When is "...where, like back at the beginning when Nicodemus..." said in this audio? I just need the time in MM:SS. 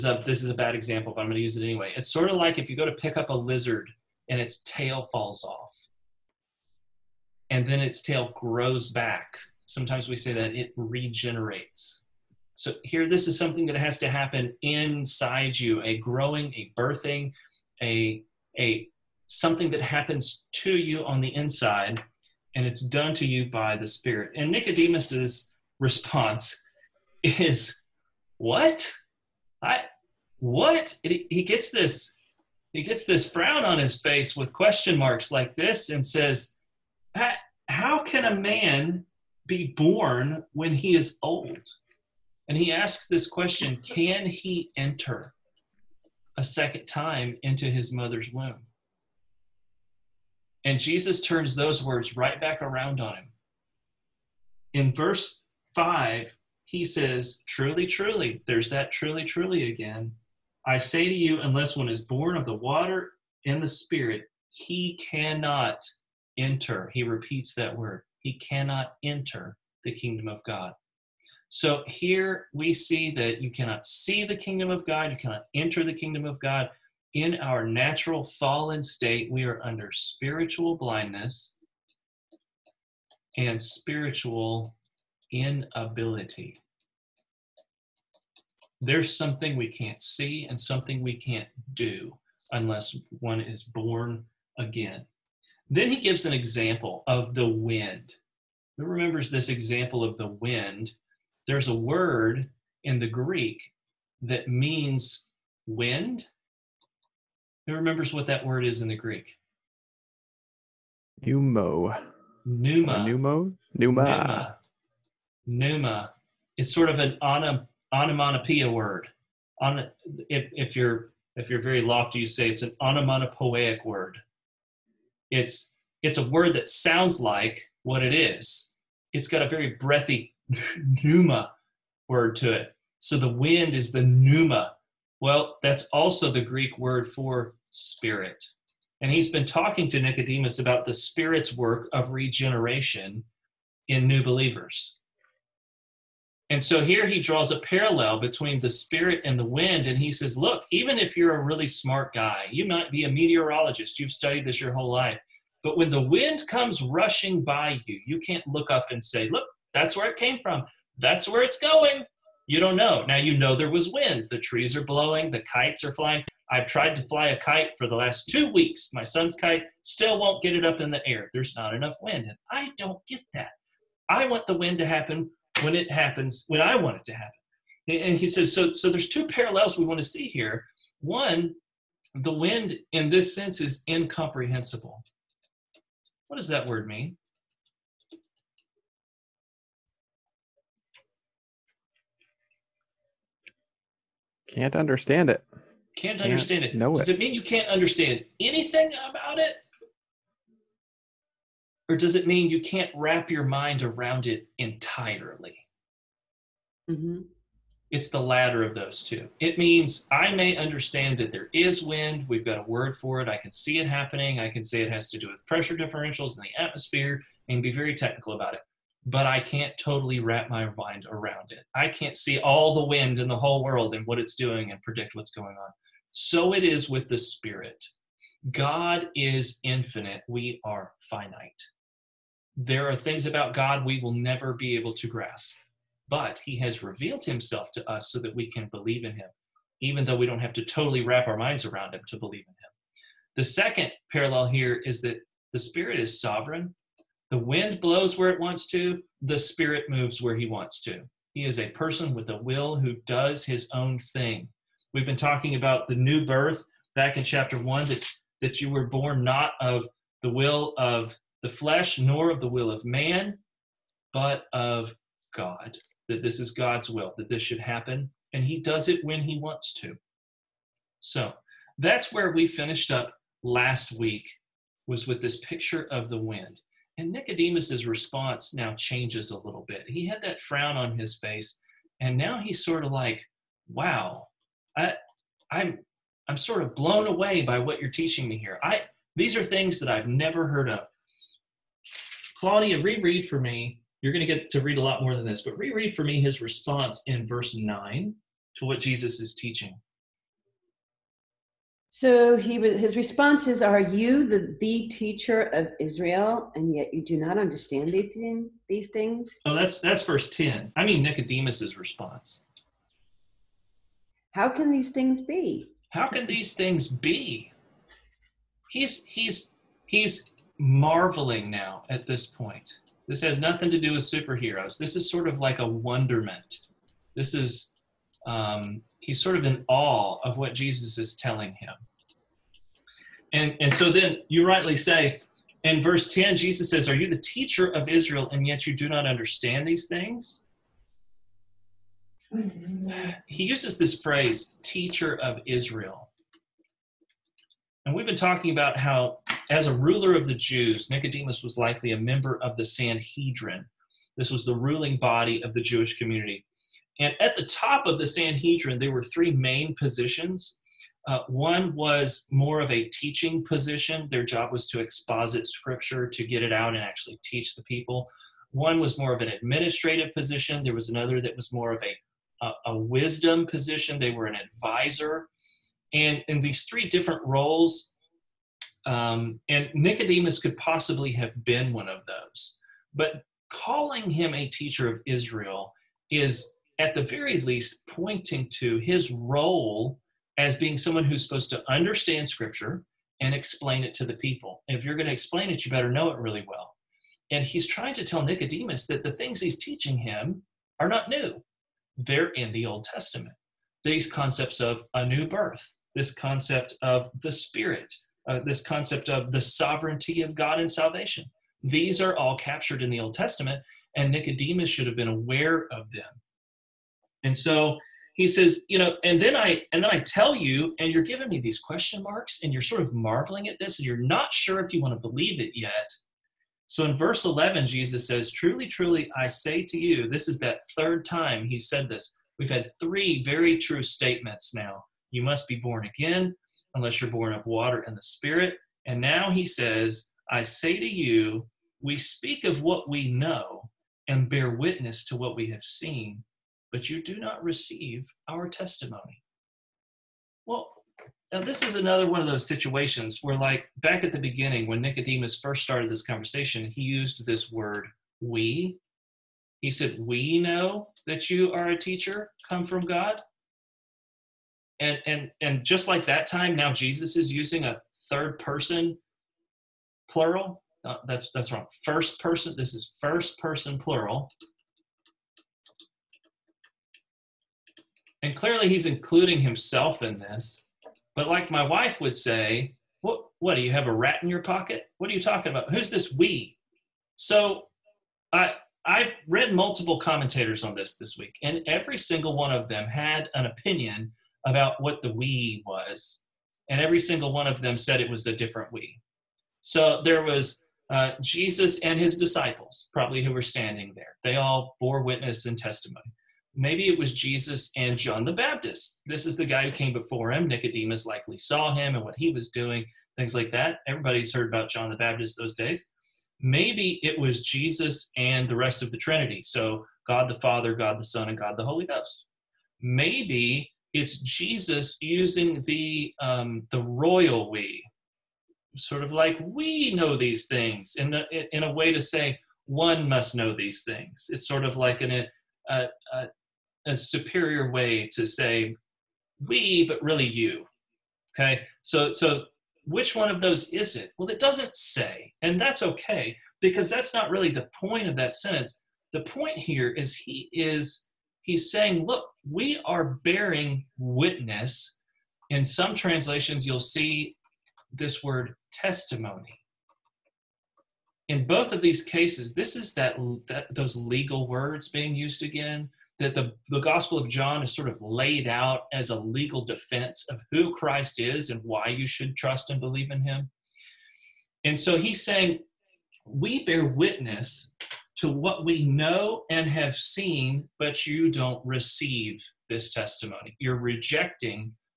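07:33.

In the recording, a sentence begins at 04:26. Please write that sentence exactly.
That this is God's will, that this should happen, and He does it when He wants to.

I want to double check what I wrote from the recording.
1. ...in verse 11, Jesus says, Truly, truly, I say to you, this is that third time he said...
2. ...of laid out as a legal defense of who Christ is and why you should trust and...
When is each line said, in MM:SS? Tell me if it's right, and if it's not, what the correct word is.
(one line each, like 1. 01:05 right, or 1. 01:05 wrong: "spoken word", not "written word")
1. 07:06 right
2. 09:27 right.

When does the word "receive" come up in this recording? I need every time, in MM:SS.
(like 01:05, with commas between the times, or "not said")
07:27, 09:41.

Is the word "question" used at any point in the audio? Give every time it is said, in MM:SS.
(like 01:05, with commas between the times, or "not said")
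00:34, 00:43, 07:01.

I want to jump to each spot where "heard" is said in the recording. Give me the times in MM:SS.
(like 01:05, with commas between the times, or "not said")
04:50, 08:34.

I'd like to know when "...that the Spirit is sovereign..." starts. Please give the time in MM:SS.
04:05.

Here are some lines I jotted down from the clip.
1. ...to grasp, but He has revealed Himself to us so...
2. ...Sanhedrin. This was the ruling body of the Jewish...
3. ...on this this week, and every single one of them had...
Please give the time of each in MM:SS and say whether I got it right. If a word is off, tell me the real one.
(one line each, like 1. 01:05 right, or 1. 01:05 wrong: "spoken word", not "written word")
1. 03:54 right
2. 05:52 right
3. 08:10 right.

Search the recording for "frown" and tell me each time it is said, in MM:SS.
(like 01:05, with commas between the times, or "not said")
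00:33, 04:40.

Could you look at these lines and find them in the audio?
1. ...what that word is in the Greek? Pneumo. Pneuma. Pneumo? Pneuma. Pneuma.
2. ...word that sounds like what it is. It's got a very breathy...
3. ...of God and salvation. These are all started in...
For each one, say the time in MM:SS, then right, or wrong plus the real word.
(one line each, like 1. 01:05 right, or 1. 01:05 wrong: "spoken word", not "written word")
1. 01:48 right
2. 02:06 right
3. 06:50 wrong: "captured", not "started".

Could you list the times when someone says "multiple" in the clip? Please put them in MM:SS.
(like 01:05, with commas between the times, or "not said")
08:09.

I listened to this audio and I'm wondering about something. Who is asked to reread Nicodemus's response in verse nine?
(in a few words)
Claudia.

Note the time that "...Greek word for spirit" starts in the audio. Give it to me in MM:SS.
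02:16.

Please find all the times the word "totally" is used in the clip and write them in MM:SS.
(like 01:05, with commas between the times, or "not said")
03:39, 04:00.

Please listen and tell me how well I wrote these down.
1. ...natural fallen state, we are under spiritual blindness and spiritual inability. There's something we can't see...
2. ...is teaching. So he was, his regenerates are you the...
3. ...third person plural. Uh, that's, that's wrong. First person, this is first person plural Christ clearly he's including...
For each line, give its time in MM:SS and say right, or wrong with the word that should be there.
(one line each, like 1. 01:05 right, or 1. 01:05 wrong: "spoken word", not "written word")
1. 01:17 right
2. 04:59 wrong: "responses", not "regenerates"
3. 07:48 wrong: "And", not "Christ".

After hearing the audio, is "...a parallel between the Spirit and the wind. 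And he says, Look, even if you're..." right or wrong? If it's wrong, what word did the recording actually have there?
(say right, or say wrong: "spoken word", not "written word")
right.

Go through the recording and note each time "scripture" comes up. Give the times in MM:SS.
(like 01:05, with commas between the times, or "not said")
06:05, 06:32.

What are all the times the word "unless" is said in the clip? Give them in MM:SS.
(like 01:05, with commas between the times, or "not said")
01:01, 01:32, 07:16.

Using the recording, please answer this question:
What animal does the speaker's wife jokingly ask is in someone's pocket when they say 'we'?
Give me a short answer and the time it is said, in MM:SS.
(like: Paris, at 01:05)
Rat, at 08:03.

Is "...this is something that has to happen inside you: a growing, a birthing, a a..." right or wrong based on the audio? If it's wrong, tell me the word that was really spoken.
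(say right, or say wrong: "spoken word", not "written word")
right.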